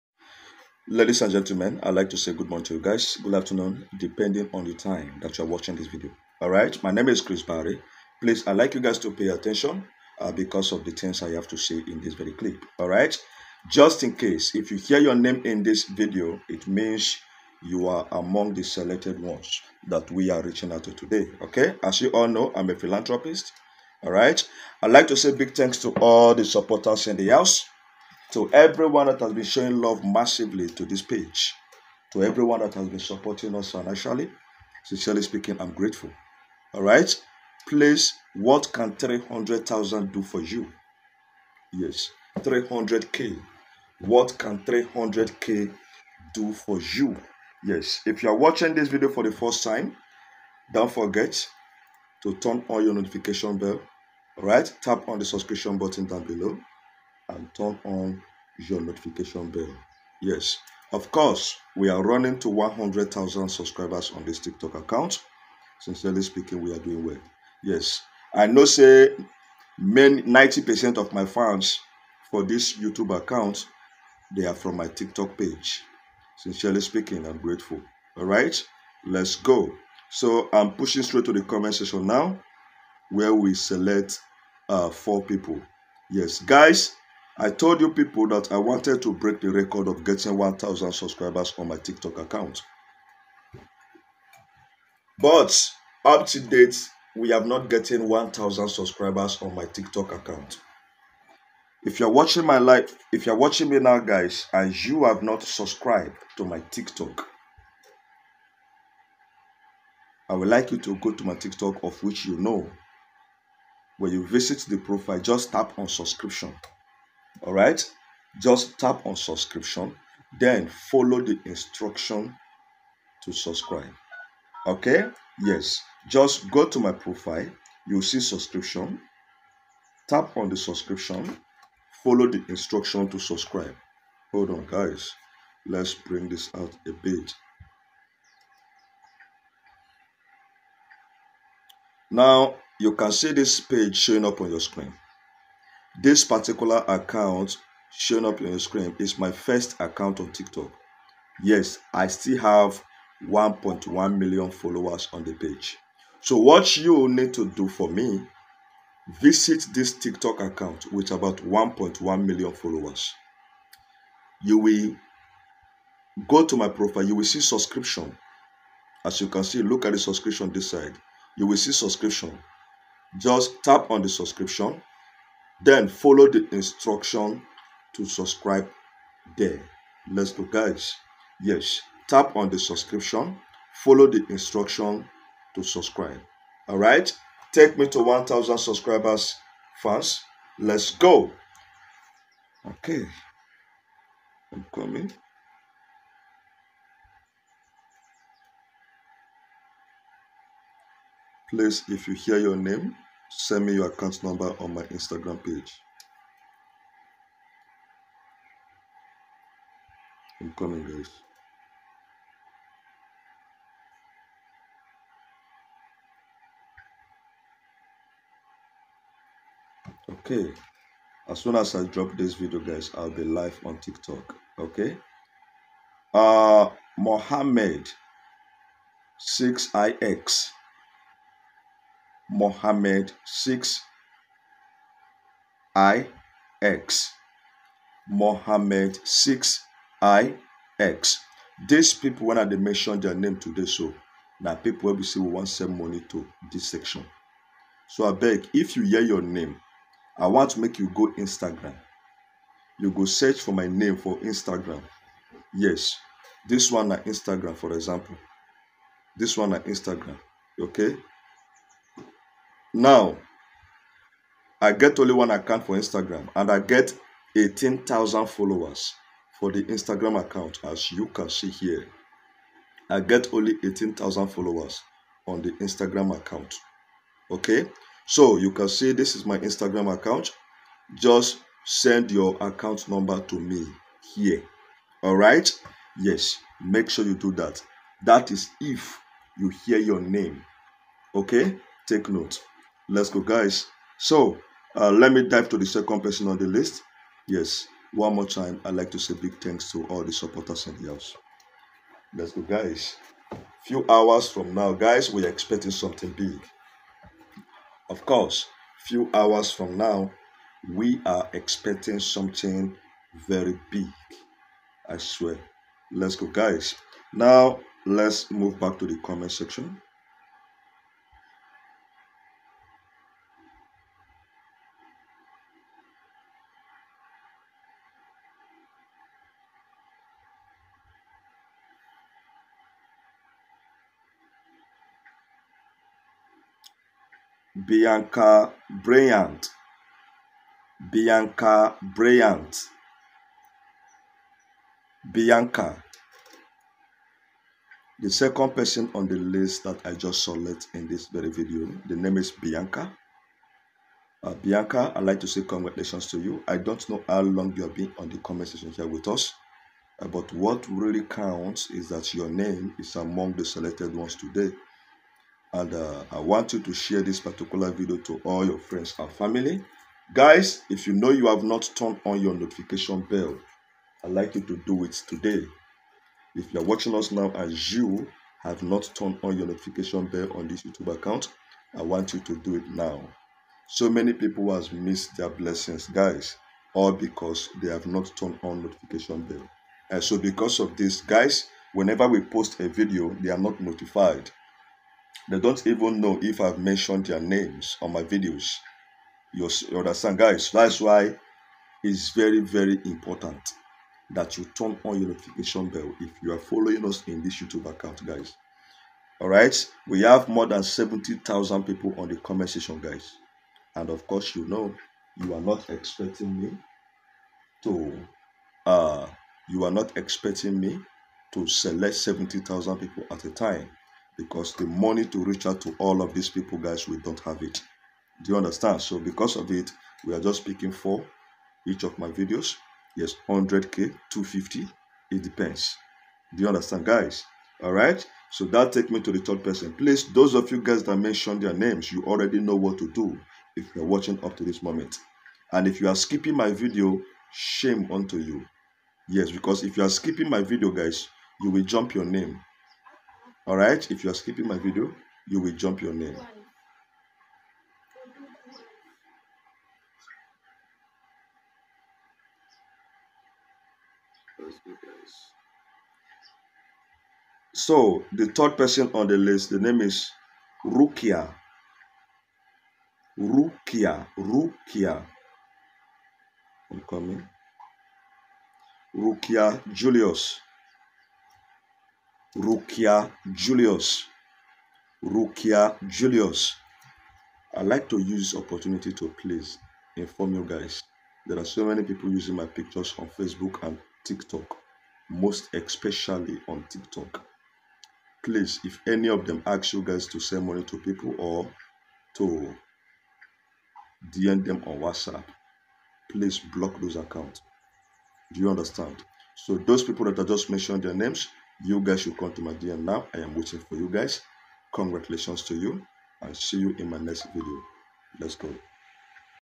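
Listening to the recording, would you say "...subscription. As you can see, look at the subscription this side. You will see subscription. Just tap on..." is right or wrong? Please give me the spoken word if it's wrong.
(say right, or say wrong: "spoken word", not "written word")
right.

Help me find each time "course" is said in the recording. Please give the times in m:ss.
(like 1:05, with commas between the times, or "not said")
1:01, 5:08, 6:54.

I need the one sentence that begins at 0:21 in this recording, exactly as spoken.
Okay, as you all know, I'm a philanthropist.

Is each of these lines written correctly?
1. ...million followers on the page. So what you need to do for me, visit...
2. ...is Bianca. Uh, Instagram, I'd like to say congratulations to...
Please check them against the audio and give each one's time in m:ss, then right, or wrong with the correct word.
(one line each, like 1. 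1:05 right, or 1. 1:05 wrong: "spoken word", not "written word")
1. 2:34 right
2. 5:52 wrong: "Bianca", not "Instagram".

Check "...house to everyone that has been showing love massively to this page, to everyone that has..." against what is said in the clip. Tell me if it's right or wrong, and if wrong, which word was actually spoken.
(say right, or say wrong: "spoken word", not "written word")
right.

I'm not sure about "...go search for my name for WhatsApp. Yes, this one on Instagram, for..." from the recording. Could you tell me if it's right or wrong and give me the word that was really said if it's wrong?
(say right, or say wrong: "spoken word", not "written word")
wrong: "Instagram", not "WhatsApp".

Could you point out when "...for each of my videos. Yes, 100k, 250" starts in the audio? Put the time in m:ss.
7:10.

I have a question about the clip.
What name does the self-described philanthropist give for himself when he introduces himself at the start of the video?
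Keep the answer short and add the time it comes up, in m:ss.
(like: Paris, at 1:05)
Chris Barry, at 0:07.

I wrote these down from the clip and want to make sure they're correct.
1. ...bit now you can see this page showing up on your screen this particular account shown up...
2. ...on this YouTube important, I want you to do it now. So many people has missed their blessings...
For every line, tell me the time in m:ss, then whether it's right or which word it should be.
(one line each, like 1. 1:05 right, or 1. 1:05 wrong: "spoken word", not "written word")
1. 2:17 right
2. 6:20 wrong: "account", not "important".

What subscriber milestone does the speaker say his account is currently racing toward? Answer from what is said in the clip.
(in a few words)
100,000.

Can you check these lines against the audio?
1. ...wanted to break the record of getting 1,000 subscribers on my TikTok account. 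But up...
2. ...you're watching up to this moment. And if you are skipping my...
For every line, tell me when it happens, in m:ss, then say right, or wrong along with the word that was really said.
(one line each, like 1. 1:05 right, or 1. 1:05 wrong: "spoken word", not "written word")
1. 1:28 right
2. 7:23 right.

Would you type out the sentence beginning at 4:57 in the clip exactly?
Yes, one more time, I'd like to say big thanks to all the supporters in the house.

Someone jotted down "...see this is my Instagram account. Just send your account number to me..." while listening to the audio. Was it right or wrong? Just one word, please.
right.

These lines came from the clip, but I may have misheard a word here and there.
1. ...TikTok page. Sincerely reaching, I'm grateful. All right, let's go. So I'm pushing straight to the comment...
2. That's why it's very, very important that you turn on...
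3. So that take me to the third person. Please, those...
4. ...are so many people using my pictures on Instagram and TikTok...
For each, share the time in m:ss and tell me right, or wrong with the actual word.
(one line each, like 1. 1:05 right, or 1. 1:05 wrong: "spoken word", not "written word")
1. 1:14 wrong: "speaking", not "reaching"
2. 6:40 right
3. 7:18 right
4. 8:11 wrong: "Facebook", not "Instagram".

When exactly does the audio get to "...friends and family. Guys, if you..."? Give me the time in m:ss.
6:08.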